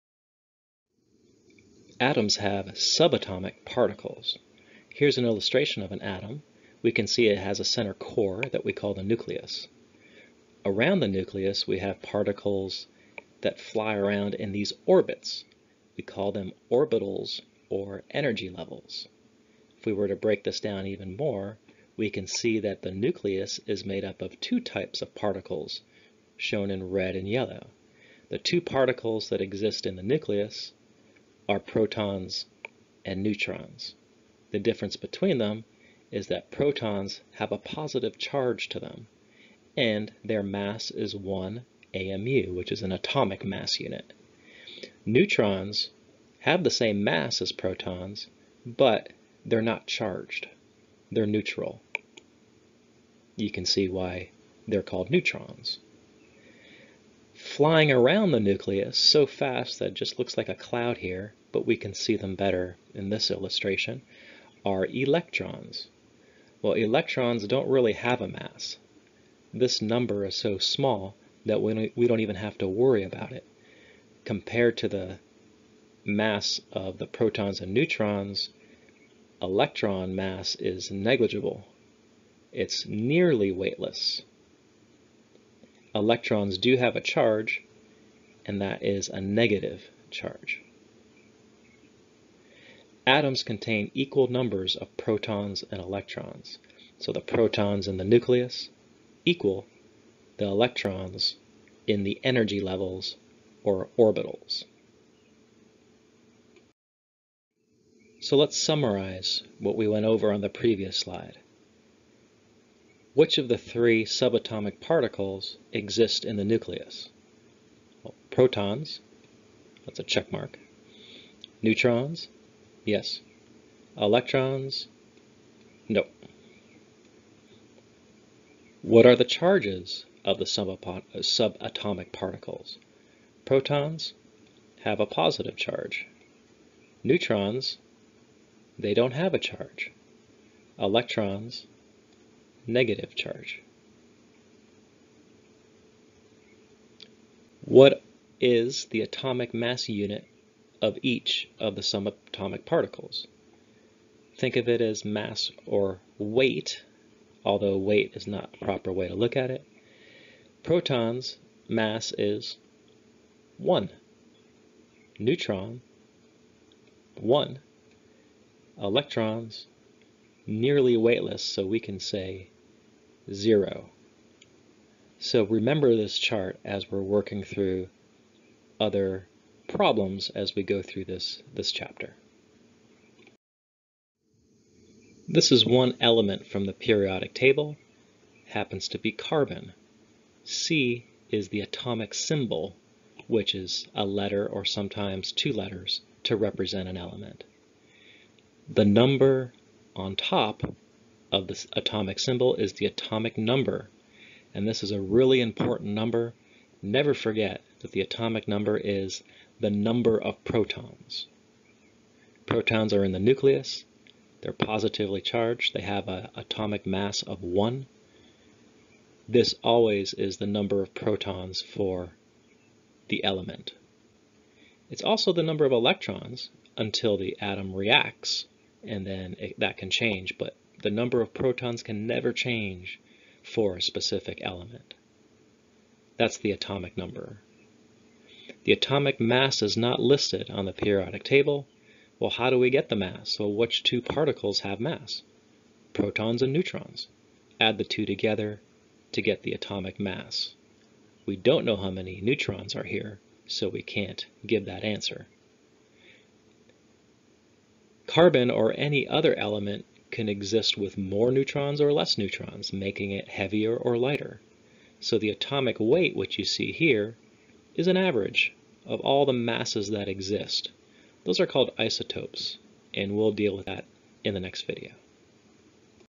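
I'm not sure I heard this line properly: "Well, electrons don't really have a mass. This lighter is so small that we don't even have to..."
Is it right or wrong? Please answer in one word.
wrong.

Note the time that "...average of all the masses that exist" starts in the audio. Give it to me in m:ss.
4:27.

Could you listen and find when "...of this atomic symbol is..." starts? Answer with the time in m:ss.
3:21.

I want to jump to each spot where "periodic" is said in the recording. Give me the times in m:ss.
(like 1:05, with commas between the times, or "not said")
3:06, 4:00.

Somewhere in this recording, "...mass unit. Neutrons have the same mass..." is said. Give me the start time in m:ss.
0:43.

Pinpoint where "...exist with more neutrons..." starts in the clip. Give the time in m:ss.
4:20.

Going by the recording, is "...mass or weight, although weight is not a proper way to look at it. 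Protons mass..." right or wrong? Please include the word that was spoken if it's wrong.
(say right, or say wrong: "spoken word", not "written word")
right.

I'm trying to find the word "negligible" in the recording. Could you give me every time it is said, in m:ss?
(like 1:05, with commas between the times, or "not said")
1:20.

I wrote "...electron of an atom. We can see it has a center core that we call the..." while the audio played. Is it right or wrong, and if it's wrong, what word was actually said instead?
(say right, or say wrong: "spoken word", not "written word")
wrong: "illustration", not "electron".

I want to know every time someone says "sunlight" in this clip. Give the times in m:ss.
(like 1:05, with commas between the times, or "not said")
not said.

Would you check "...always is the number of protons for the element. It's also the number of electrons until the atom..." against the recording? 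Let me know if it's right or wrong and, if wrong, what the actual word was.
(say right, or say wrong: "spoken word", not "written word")
right.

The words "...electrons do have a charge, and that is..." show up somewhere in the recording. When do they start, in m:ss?
1:25.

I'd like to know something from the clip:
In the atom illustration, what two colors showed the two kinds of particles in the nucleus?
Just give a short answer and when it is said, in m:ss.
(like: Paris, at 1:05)
red and yellow, at 0:26.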